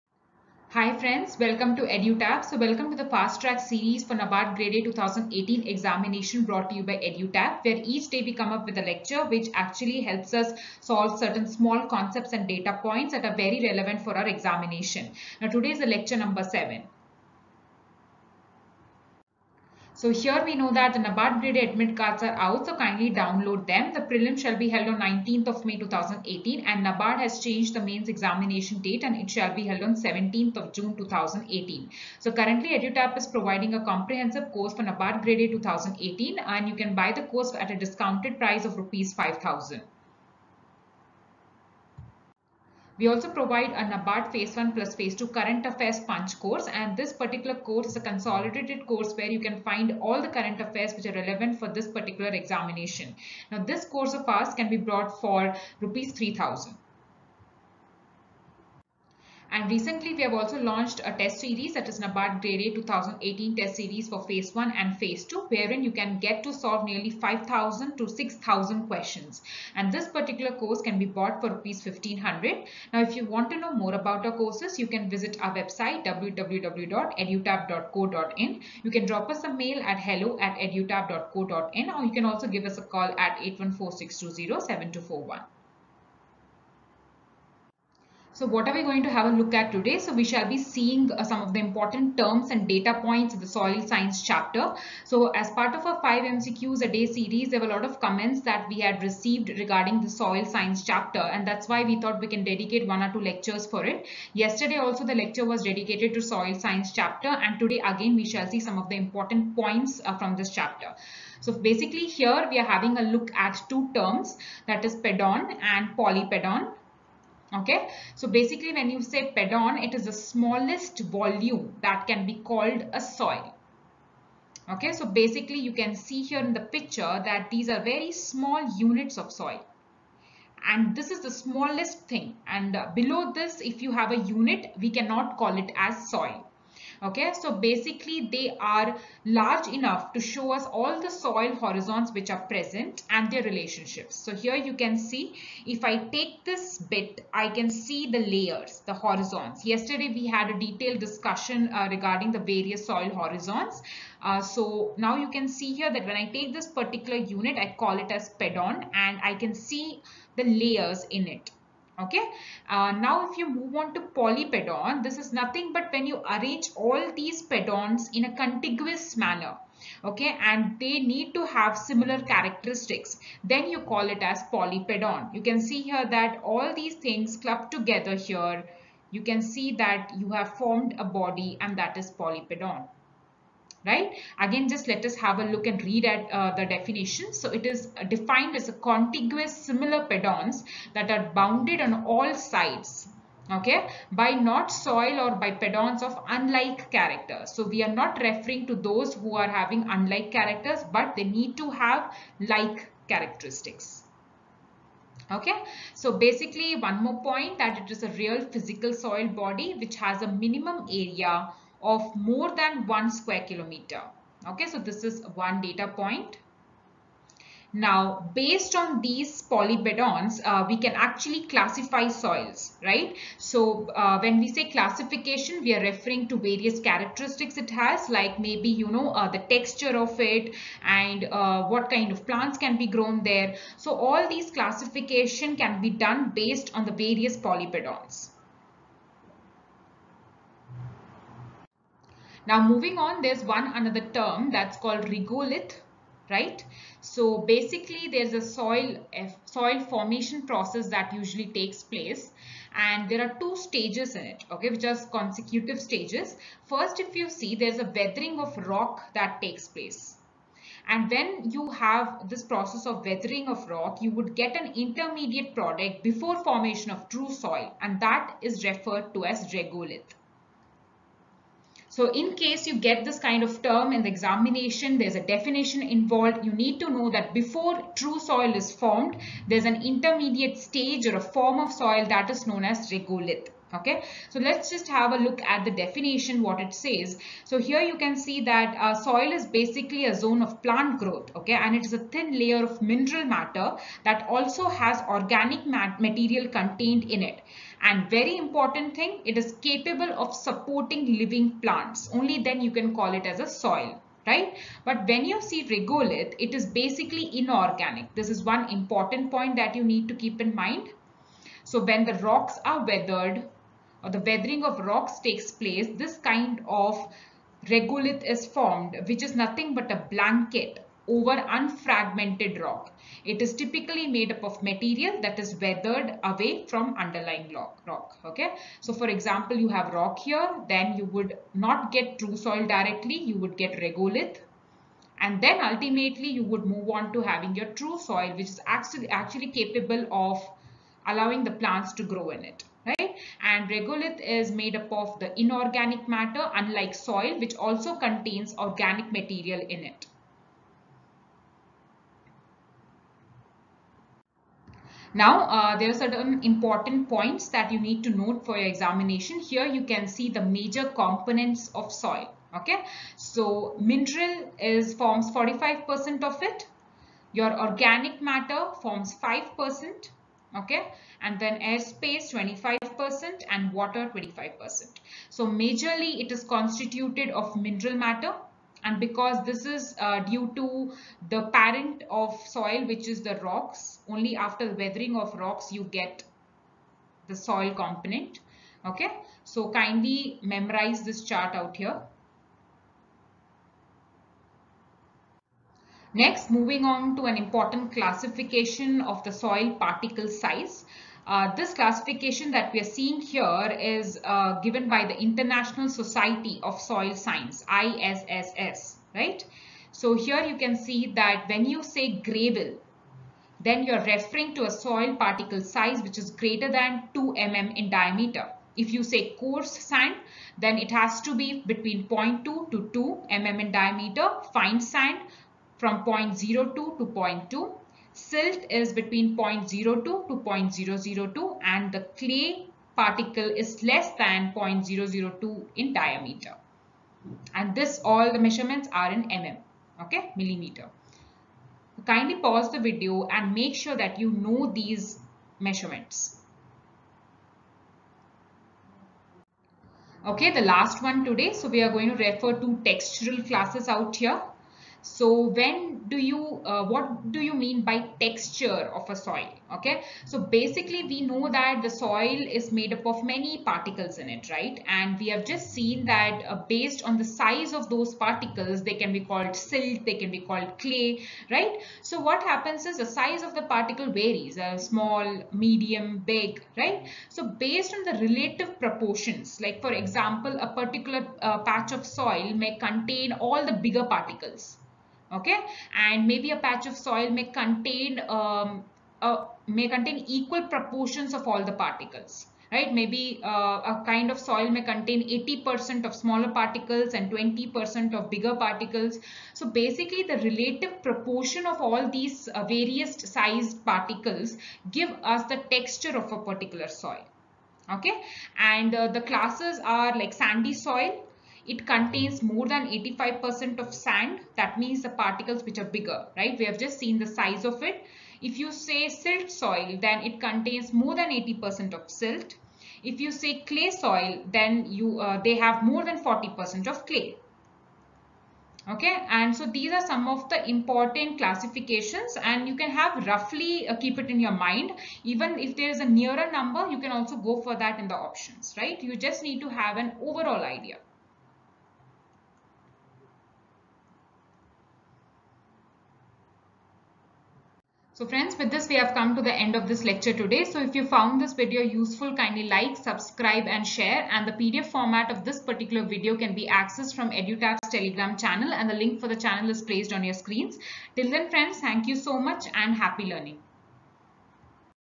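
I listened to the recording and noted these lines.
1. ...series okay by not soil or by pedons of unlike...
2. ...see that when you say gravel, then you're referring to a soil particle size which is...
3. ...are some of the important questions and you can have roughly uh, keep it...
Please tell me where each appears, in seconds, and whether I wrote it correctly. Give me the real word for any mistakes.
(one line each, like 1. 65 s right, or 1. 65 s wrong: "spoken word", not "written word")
1. 192 s wrong: "sides", not "series"
2. 410 s right
3. 529 s wrong: "classifications", not "questions".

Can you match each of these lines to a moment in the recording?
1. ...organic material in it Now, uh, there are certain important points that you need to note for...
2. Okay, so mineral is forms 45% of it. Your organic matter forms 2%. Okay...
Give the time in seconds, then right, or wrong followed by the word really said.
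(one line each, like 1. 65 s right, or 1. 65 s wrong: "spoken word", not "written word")
1. 348 s right
2. 362 s wrong: "5", not "2".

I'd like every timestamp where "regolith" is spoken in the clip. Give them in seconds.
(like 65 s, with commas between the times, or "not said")
245 s, 269 s, 282 s, 305 s, 317 s, 333 s, 343 s.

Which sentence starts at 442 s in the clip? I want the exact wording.
Kindly pause the video and make sure that you know these measurements.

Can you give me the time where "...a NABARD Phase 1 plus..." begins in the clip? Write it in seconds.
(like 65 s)
43 s.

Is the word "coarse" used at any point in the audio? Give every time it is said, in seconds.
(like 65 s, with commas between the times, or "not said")
419 s.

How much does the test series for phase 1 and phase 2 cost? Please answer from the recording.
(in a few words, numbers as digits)
Rs 1500.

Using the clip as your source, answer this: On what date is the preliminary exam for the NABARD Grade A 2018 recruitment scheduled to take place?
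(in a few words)
19th May 2018.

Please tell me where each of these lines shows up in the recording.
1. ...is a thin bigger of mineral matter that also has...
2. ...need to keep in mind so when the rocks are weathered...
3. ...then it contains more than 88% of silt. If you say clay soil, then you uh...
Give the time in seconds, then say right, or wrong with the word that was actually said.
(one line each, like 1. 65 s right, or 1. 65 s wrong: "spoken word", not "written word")
1. 291 s wrong: "layer", not "bigger"
2. 309 s right
3. 520 s wrong: "80", not "88".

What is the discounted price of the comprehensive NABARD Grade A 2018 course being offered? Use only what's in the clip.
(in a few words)
Rs 5000.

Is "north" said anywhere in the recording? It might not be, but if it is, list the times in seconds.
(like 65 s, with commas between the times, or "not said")
not said.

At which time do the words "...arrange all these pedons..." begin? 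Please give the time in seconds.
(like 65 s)
166 s.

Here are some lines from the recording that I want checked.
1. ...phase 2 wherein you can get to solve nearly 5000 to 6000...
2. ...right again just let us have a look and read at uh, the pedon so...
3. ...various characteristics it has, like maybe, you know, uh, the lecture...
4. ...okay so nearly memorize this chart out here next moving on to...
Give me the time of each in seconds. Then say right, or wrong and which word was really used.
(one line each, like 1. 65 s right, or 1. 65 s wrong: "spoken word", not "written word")
1. 64 s right
2. 183 s wrong: "definition", not "pedon"
3. 226 s wrong: "texture", not "lecture"
4. 388 s wrong: "kindly", not "nearly".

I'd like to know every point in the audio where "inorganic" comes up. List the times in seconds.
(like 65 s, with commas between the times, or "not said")
307 s, 345 s.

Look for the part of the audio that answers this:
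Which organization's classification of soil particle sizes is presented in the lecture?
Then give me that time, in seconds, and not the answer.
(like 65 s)
405 s.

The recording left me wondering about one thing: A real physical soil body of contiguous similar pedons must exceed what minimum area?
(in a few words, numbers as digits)
1 square kilometer.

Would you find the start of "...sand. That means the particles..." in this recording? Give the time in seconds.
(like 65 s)
513 s.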